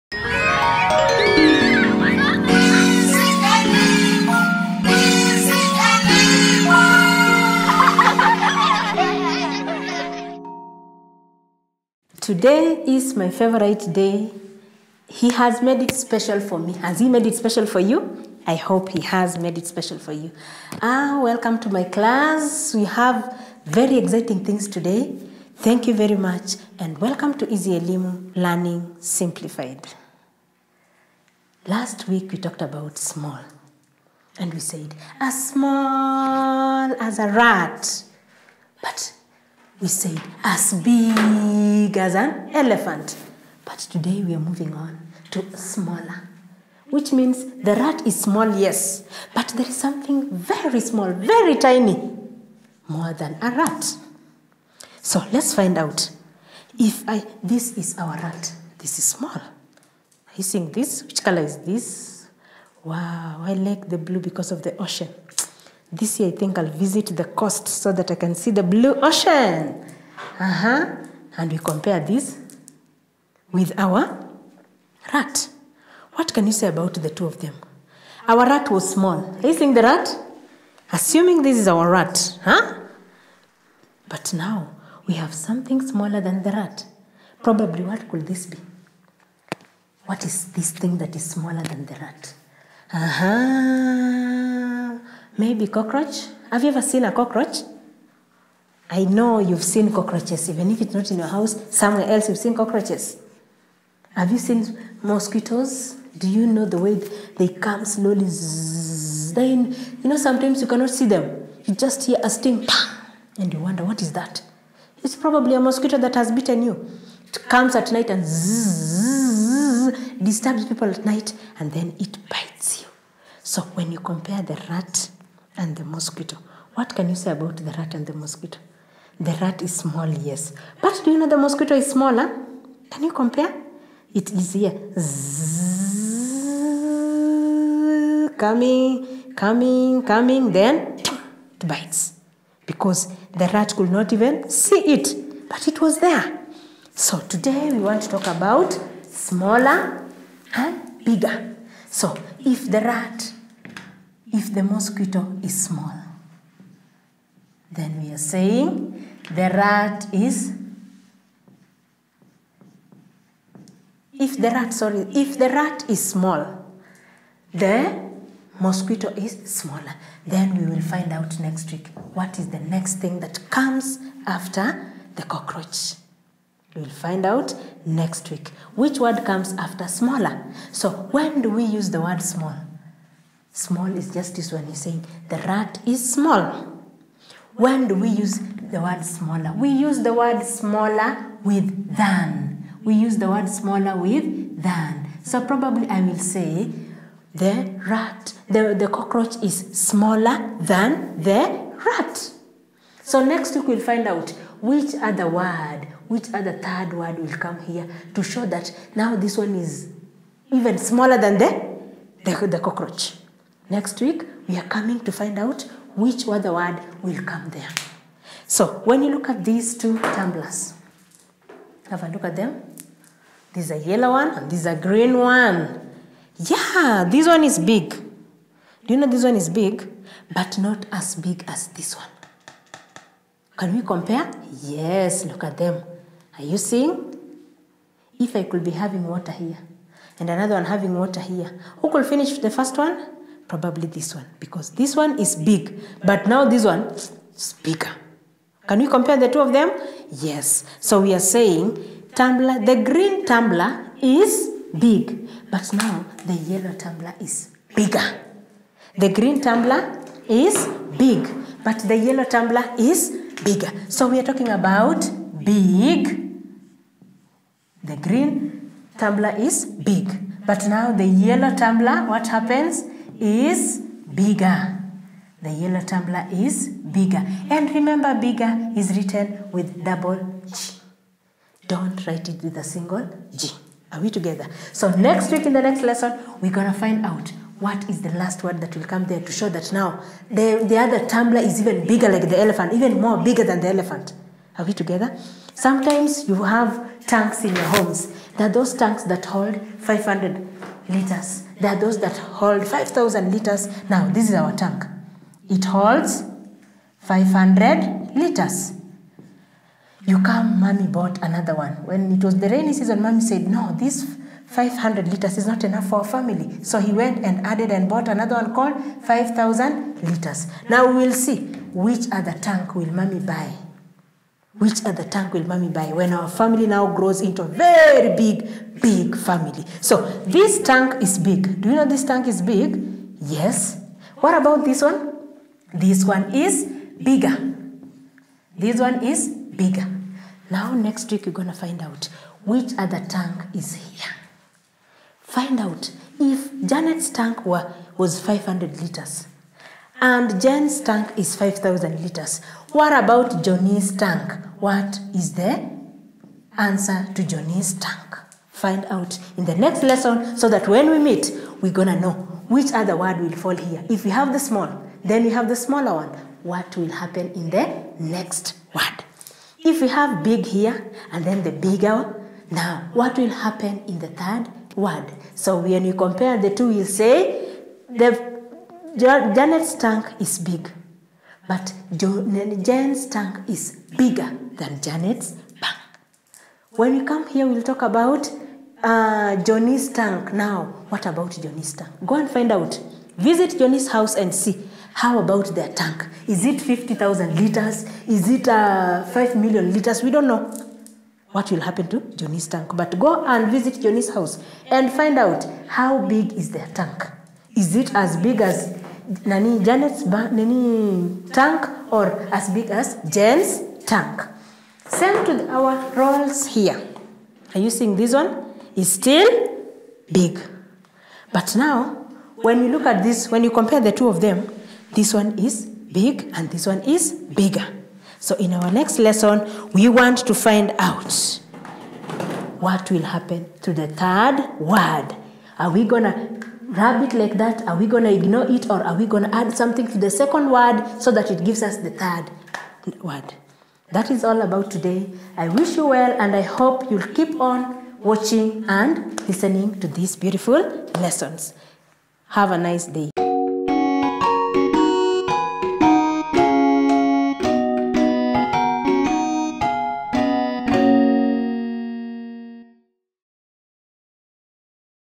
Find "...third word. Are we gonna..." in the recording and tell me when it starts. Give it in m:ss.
7:13.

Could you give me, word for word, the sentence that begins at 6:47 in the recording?
Is it as big as nani Janet's nani tank or as big as Jen's tank.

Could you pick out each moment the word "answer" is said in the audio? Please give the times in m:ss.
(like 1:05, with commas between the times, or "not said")
5:56.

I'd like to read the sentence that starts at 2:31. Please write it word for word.
So if the rat if the mosquito is small.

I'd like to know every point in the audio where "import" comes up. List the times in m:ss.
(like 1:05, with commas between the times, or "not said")
not said.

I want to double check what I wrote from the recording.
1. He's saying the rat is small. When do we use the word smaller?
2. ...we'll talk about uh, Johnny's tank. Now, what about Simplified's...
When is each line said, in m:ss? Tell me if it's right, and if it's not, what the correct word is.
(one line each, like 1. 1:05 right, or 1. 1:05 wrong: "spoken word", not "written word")
1. 3:04 right
2. 6:27 wrong: "Johnny", not "Simplified".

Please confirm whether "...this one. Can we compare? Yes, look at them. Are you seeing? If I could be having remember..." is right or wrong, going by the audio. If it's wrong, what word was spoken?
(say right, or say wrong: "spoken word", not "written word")
wrong: "water", not "remember".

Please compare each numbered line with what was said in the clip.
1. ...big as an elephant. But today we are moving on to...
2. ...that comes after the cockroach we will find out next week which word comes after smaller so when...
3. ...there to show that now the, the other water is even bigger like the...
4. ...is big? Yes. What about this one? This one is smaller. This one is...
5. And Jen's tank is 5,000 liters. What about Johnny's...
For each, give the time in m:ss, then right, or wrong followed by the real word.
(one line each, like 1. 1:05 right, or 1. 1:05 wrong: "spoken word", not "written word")
1. 0:40 right
2. 2:53 right
3. 4:49 wrong: "tumbler", not "water"
4. 5:32 wrong: "bigger", not "smaller"
5. 5:50 right.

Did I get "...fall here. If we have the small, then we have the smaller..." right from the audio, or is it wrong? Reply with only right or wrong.
right.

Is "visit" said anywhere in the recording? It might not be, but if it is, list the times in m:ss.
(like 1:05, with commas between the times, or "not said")
1:06, 6:33, 6:43.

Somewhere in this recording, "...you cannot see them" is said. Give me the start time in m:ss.
1:50.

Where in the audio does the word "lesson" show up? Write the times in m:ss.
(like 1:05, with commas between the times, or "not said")
4:45, 5:59, 7:08, 7:30.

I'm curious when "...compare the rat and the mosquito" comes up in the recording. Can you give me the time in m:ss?
2:03.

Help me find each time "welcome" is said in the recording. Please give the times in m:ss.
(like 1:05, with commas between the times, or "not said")
0:21, 0:26.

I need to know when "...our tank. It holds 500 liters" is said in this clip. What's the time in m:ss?
5:04.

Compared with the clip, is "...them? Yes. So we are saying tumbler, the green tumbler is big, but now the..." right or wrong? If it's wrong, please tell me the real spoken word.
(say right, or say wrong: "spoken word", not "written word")
right.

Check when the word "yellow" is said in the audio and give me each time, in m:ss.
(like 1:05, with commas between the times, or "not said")
3:43, 4:16, 4:21, 4:31, 4:35.